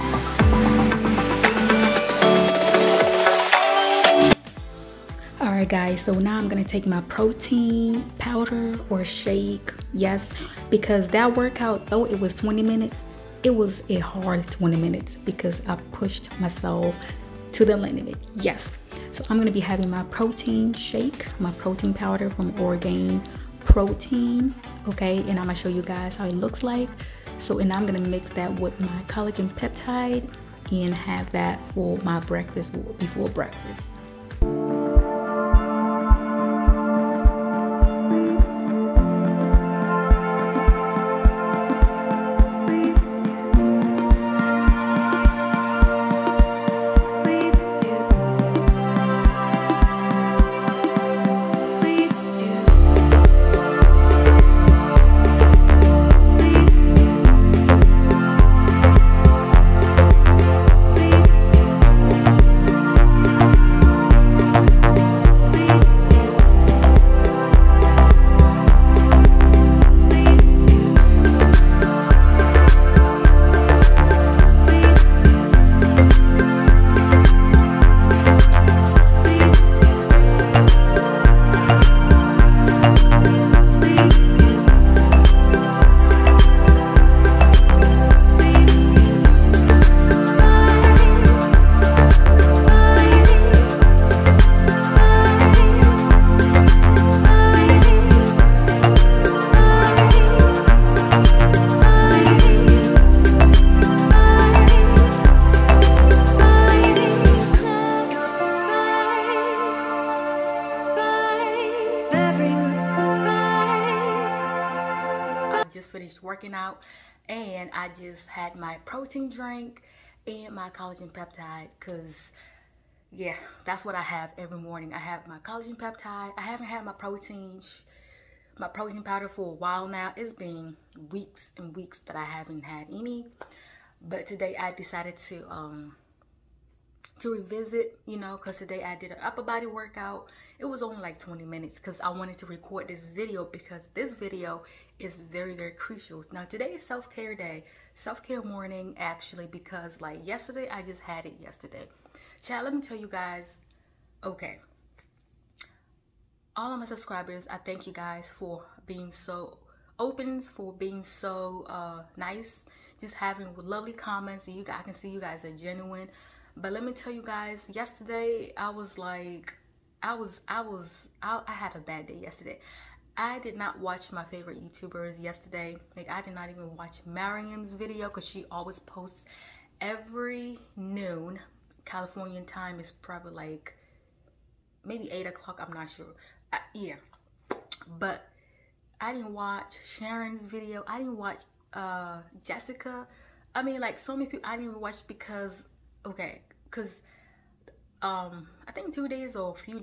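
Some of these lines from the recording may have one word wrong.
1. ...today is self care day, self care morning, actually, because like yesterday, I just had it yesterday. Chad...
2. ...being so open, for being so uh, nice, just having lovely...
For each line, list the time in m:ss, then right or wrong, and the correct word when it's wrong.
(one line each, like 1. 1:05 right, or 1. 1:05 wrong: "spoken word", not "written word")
1. 2:26 right
2. 2:38 right.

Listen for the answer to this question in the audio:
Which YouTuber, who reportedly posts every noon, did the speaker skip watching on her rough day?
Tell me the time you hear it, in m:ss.
2:57.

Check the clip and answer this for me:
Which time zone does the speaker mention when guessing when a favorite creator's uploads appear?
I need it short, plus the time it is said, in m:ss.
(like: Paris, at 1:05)
Californian time, at 3:01.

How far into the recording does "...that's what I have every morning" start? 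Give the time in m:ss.
2:03.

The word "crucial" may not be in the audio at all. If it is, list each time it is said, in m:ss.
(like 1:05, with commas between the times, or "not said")
2:25.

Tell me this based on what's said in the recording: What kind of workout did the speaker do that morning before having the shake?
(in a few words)
upper body.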